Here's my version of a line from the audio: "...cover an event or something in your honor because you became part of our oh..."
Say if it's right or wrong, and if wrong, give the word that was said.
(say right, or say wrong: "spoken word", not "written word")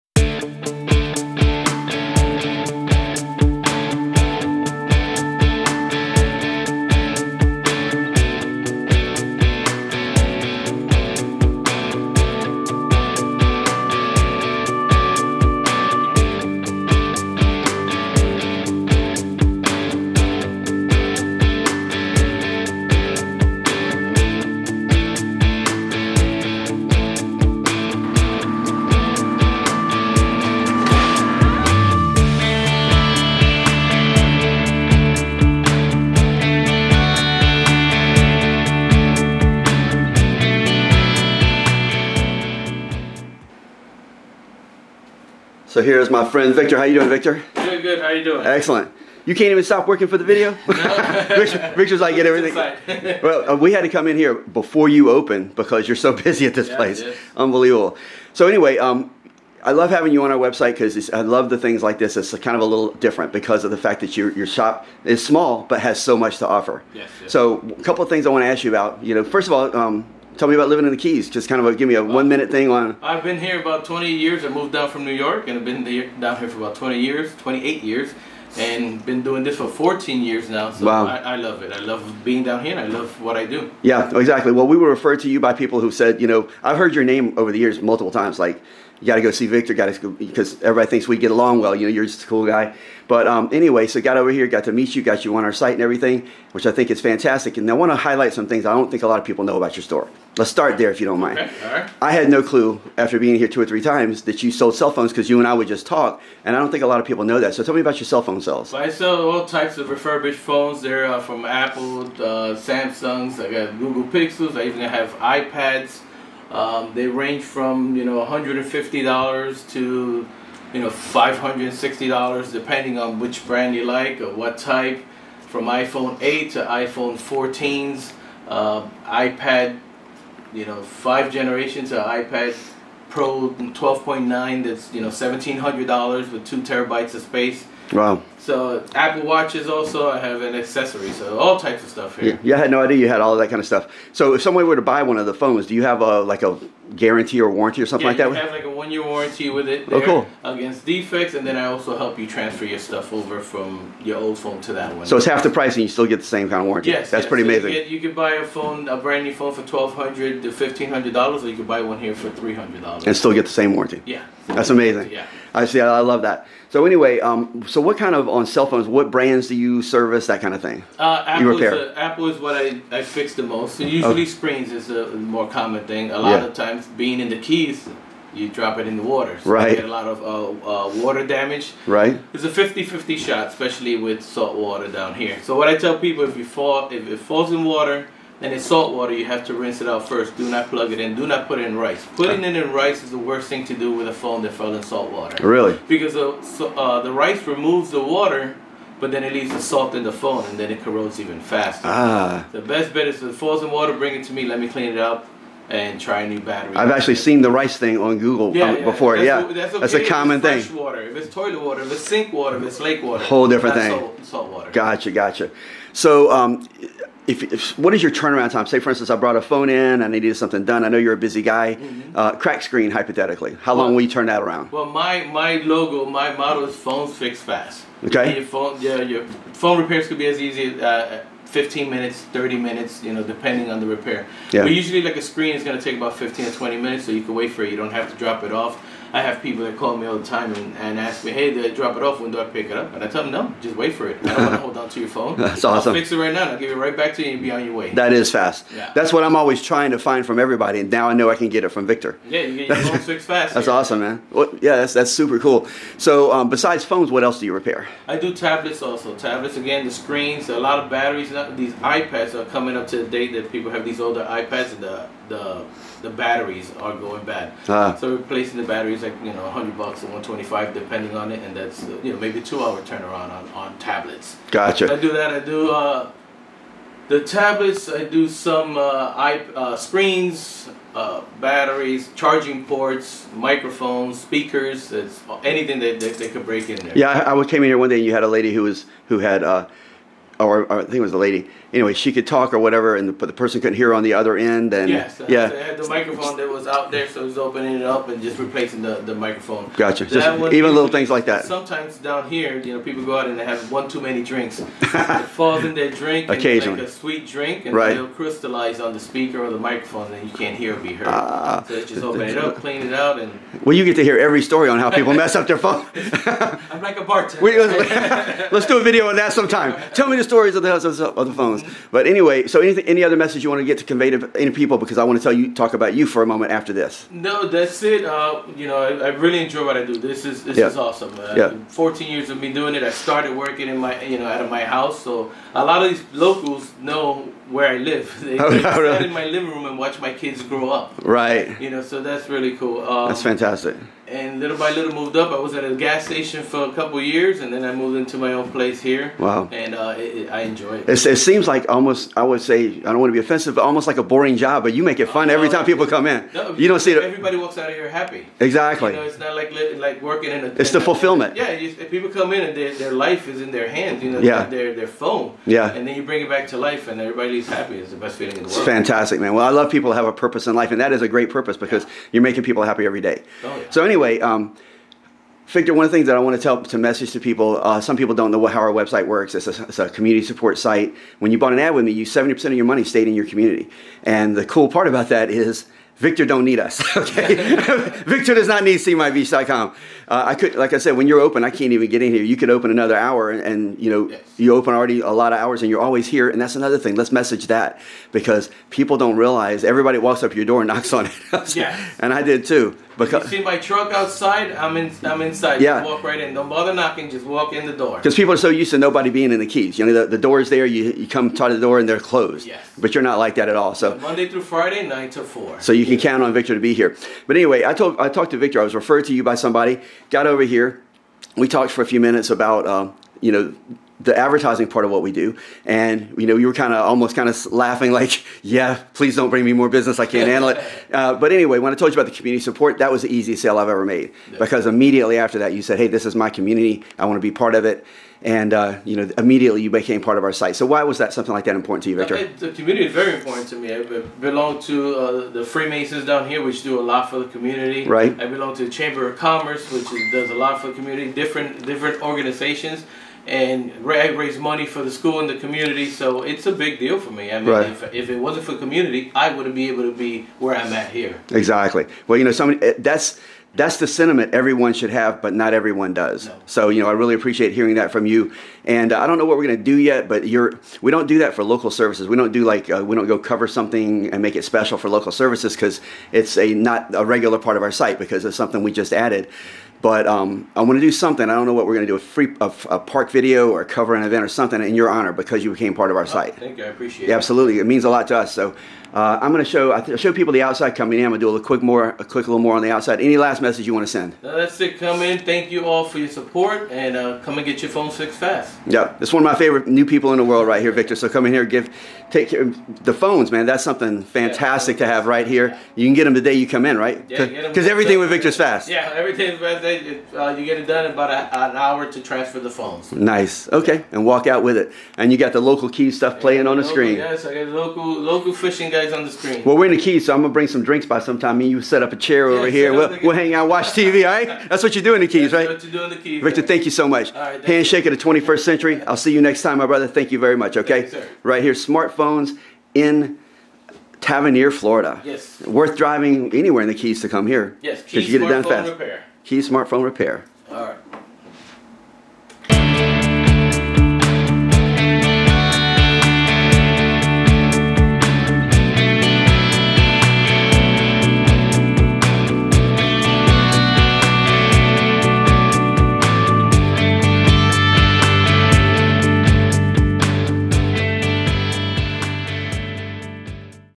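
right.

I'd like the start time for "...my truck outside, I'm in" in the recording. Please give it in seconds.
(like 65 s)
403 s.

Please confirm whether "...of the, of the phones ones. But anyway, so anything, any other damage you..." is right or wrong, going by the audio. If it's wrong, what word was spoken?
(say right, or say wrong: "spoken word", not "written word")
wrong: "message", not "damage".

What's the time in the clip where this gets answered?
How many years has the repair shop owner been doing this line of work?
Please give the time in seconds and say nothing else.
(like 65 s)
79 s.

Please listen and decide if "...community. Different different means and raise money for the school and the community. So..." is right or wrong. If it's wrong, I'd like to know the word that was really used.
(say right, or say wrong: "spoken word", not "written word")
wrong: "organizations", not "means".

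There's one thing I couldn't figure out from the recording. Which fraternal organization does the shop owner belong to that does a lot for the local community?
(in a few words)
Freemasons.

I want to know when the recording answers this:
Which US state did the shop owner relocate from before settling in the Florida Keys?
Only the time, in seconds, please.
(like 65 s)
75 s.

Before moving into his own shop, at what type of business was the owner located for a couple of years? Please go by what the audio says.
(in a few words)
gas station.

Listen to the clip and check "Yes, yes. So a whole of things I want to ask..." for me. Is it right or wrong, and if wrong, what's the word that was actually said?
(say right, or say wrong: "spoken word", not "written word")
wrong: "couple", not "whole".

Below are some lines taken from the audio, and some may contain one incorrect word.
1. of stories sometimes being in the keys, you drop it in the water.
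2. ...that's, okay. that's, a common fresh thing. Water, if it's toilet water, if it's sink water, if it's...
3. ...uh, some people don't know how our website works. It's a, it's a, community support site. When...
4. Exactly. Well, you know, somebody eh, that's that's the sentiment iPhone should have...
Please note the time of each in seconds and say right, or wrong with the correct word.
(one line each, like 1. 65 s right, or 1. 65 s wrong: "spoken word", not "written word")
1. 176 s wrong: "times", not "stories"
2. 209 s right
3. 377 s right
4. 461 s wrong: "everyone", not "iPhone".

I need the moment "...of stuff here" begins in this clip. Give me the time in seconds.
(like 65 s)
141 s.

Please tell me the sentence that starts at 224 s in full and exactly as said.
Well, my my logo, my motto is phones fix fast.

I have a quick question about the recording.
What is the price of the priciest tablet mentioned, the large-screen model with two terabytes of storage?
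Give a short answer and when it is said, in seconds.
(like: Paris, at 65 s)
$1,700, at 135 s.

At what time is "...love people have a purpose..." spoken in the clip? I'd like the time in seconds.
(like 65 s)
369 s.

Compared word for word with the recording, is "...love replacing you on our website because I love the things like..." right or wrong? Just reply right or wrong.
wrong.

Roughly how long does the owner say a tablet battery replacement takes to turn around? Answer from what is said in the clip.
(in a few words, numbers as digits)
2 hours.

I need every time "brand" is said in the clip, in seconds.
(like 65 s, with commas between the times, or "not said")
123 s, 158 s, 169 s.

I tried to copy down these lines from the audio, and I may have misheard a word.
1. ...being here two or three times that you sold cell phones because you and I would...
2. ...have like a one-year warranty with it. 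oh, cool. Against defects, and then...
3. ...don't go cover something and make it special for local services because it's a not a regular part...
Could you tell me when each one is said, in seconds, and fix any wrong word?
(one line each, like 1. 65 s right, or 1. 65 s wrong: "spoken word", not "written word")
1. 103 s right
2. 148 s right
3. 472 s right.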